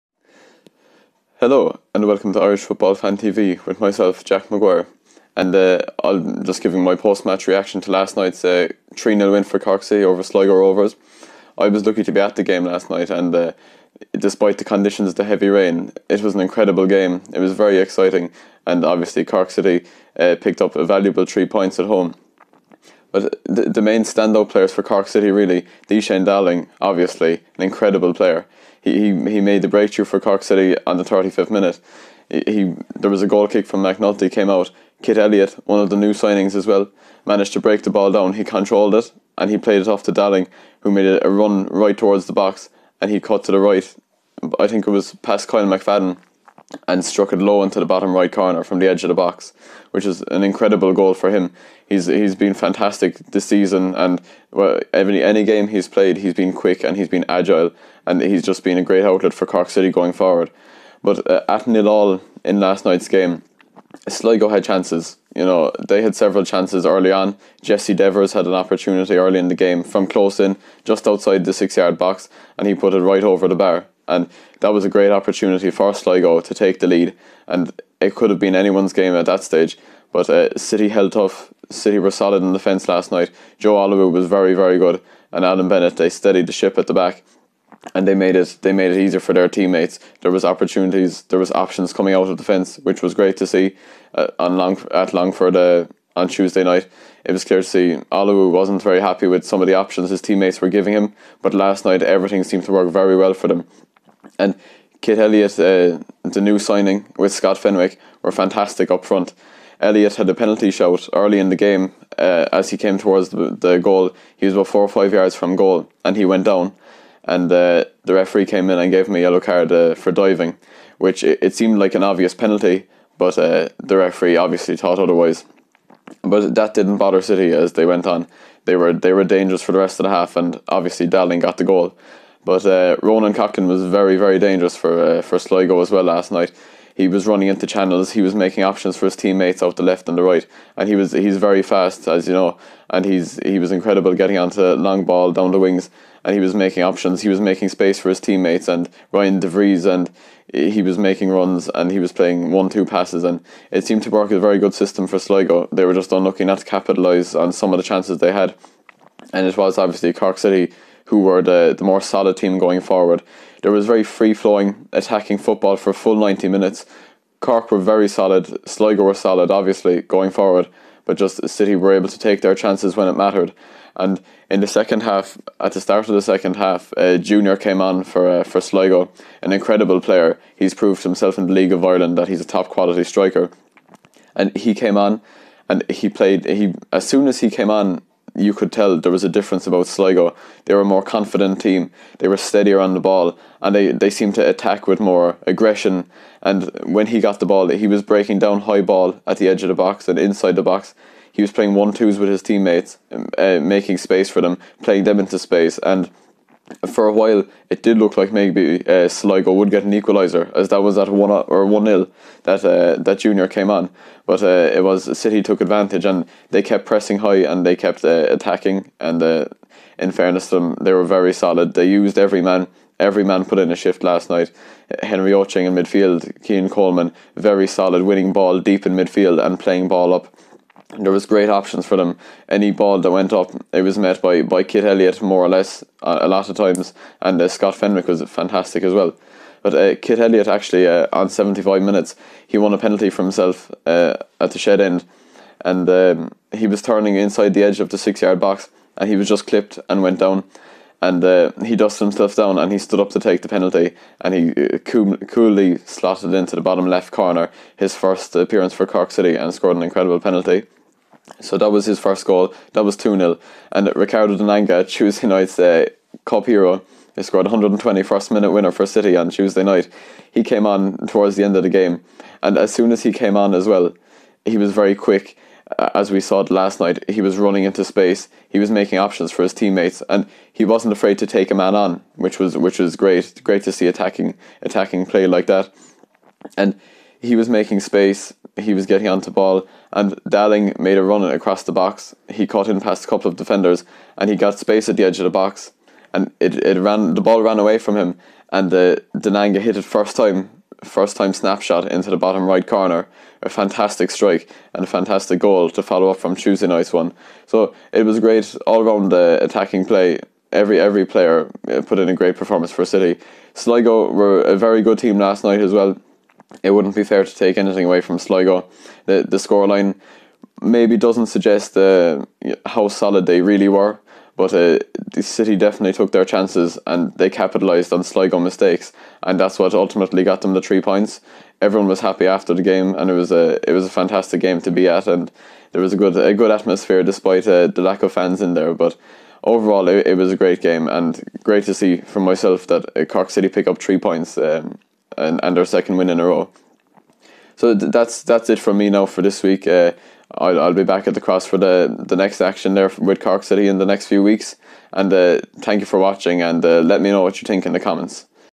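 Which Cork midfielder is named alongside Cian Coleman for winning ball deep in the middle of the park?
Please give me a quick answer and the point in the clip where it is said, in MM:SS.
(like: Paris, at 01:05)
Henry Ochieng, at 03:45.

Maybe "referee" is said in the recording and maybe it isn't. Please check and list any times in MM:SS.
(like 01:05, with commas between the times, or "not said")
01:58, 02:03.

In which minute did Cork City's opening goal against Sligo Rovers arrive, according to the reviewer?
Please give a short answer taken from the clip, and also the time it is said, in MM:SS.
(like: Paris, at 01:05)
35th, at 00:31.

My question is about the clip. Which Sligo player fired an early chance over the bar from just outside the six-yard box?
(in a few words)
Jesse Devers.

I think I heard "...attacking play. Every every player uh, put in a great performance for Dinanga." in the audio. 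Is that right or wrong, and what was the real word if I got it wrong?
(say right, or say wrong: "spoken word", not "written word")
wrong: "City", not "Dinanga".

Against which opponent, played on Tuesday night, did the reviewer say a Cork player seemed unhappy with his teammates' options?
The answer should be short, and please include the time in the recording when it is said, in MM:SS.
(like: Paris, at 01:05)
Longford, at 01:35.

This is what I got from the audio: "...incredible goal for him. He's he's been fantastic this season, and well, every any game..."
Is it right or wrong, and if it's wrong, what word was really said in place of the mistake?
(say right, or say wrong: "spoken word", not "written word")
right.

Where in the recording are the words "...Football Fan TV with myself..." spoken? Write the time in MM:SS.
00:02.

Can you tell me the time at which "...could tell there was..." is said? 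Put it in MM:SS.
03:08.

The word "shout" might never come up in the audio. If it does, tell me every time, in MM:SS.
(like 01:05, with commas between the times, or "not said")
01:50.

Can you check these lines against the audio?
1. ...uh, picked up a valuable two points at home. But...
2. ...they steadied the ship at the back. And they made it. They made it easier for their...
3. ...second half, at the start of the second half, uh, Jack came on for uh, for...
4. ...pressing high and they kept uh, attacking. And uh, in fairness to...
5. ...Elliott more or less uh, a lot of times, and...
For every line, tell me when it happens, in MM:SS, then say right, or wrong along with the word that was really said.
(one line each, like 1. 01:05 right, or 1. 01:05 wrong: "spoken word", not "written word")
1. 00:20 wrong: "three", not "two"
2. 01:25 right
3. 02:54 wrong: "Junior", not "Jack"
4. 03:36 right
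5. 03:54 right.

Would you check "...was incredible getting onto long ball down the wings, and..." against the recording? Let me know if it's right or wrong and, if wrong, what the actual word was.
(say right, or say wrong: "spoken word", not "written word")
right.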